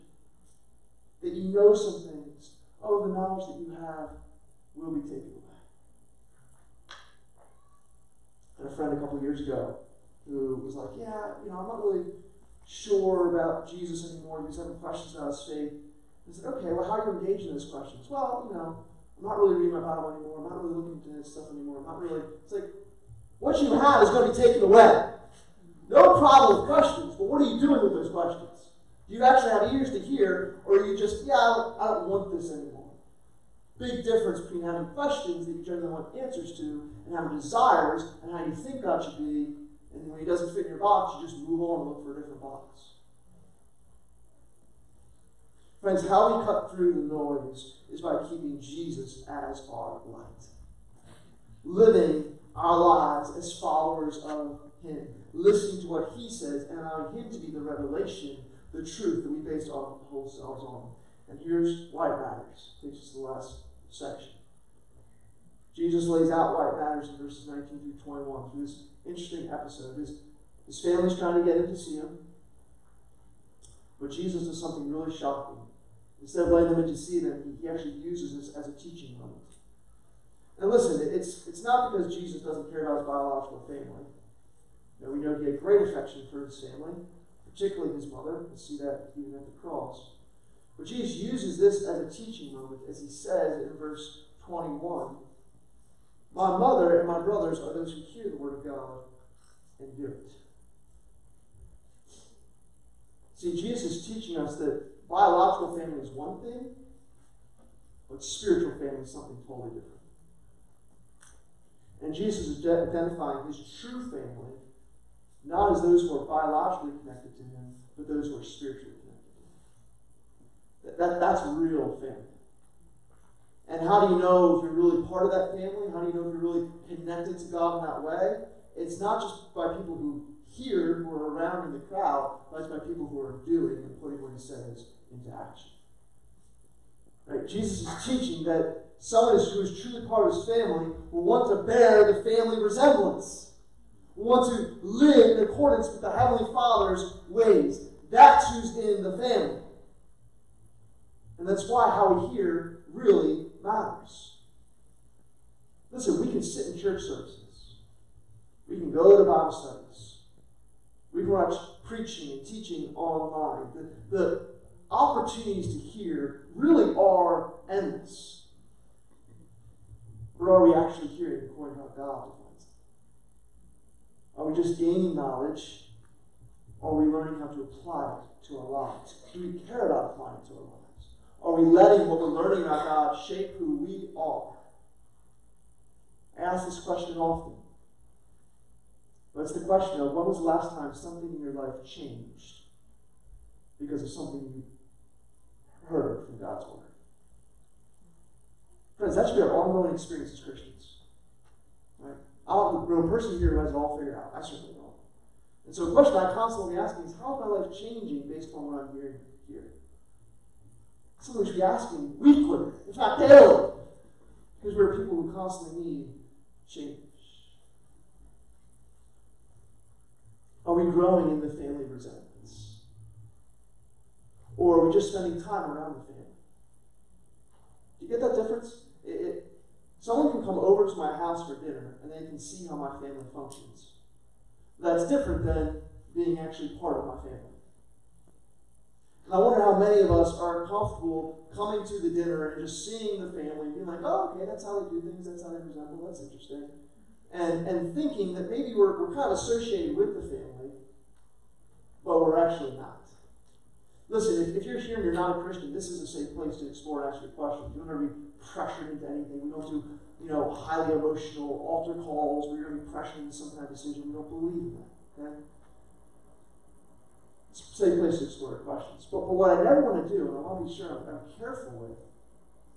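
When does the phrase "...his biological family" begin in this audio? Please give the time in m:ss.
1:23.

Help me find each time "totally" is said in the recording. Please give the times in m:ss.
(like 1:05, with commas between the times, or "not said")
1:49.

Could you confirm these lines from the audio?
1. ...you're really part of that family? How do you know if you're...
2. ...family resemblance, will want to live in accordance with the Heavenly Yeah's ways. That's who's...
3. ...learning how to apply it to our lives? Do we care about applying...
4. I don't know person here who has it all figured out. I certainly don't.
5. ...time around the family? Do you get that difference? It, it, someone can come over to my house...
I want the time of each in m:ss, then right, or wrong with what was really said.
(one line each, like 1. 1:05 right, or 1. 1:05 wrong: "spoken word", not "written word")
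1. 2:04 right
2. 2:22 wrong: "Father", not "Yeah"
3. 2:57 right
4. 3:22 right
5. 3:45 right.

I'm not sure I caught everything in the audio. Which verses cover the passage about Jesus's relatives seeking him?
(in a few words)
19 through 21.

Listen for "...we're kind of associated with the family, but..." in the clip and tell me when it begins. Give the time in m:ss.
4:09.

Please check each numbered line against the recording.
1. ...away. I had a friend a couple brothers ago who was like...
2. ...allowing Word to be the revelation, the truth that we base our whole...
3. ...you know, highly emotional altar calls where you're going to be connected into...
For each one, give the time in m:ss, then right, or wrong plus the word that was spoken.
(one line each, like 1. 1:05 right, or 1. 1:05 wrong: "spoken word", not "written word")
1. 0:05 wrong: "years", not "brothers"
2. 0:56 wrong: "Him", not "Word"
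3. 4:20 wrong: "pressured", not "connected".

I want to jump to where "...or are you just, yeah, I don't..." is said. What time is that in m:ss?
0:30.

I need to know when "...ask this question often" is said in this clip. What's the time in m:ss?
3:06.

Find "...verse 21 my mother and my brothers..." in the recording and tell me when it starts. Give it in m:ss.
1:33.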